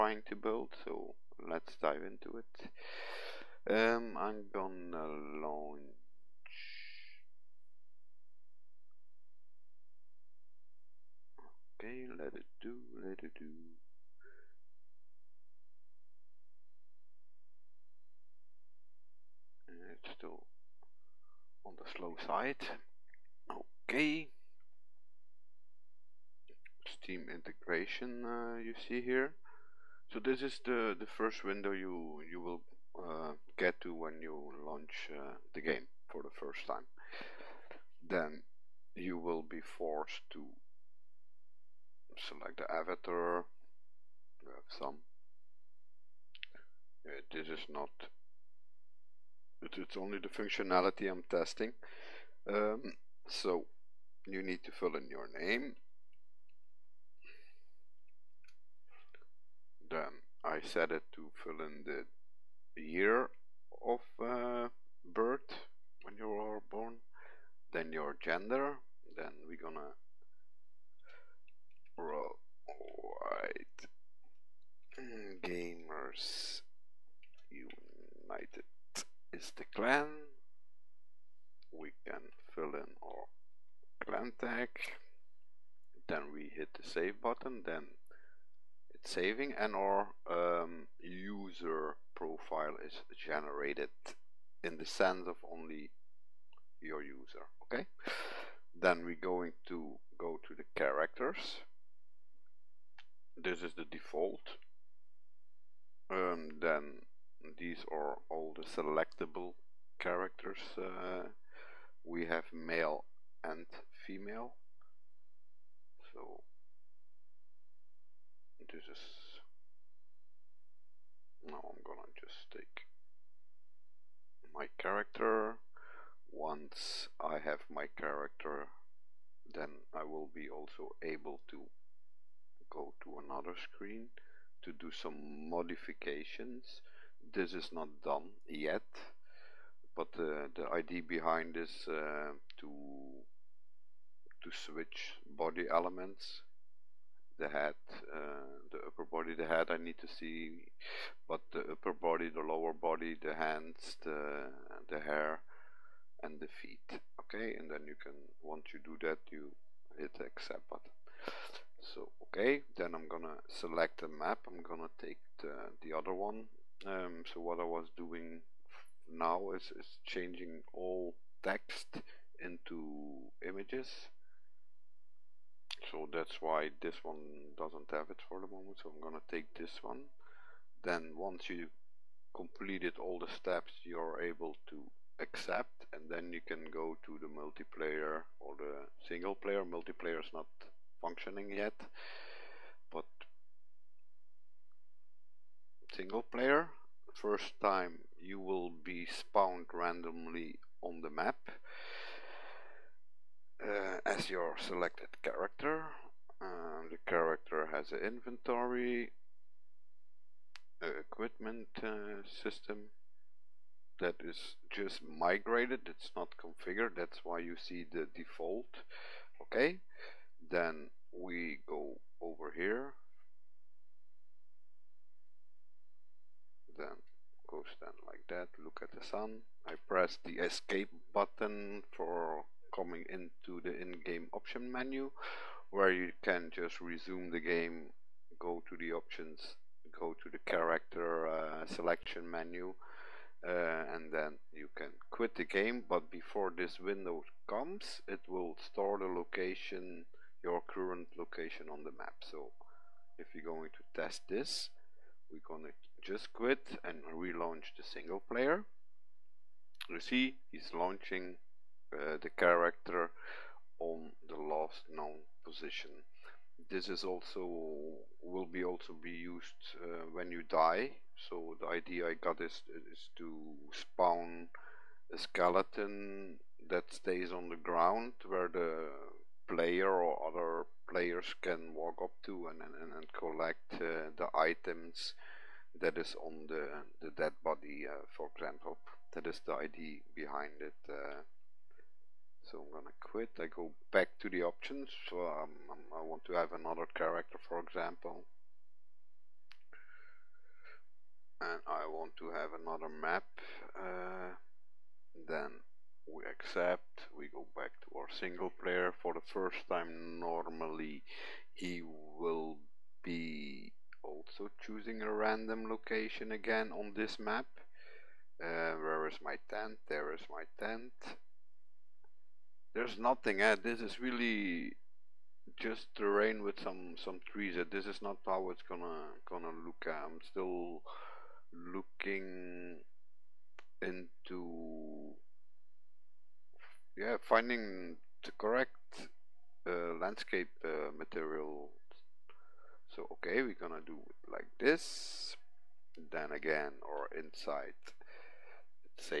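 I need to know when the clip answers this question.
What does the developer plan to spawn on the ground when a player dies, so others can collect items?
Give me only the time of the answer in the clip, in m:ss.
4:35.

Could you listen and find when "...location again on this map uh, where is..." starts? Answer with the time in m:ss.
5:15.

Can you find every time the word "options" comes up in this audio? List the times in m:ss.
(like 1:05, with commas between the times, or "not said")
3:54, 3:58, 4:54.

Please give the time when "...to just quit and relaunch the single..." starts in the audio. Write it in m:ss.
4:15.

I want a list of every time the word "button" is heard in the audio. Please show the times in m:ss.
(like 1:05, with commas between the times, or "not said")
1:27, 2:40, 3:51.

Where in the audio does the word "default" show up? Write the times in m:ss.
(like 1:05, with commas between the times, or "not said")
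1:43, 3:38.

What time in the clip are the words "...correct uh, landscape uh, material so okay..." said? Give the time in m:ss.
5:38.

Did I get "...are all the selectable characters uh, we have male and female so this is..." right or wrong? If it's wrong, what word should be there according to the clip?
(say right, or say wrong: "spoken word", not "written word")
right.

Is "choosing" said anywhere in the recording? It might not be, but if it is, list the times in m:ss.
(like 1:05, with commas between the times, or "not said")
5:14.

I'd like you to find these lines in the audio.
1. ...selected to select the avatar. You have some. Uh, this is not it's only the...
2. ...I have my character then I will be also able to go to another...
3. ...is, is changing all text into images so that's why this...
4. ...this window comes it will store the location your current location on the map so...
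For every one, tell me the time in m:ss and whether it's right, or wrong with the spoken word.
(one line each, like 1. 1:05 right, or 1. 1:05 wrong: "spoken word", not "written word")
1. 0:39 wrong: "forced", not "selected"
2. 2:07 right
3. 2:49 right
4. 4:06 right.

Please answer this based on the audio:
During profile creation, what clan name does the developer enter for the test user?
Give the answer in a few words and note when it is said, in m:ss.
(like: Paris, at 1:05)
White Gamers United, at 1:12.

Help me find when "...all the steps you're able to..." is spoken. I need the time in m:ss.
3:02.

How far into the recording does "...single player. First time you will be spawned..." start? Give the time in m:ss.
3:15.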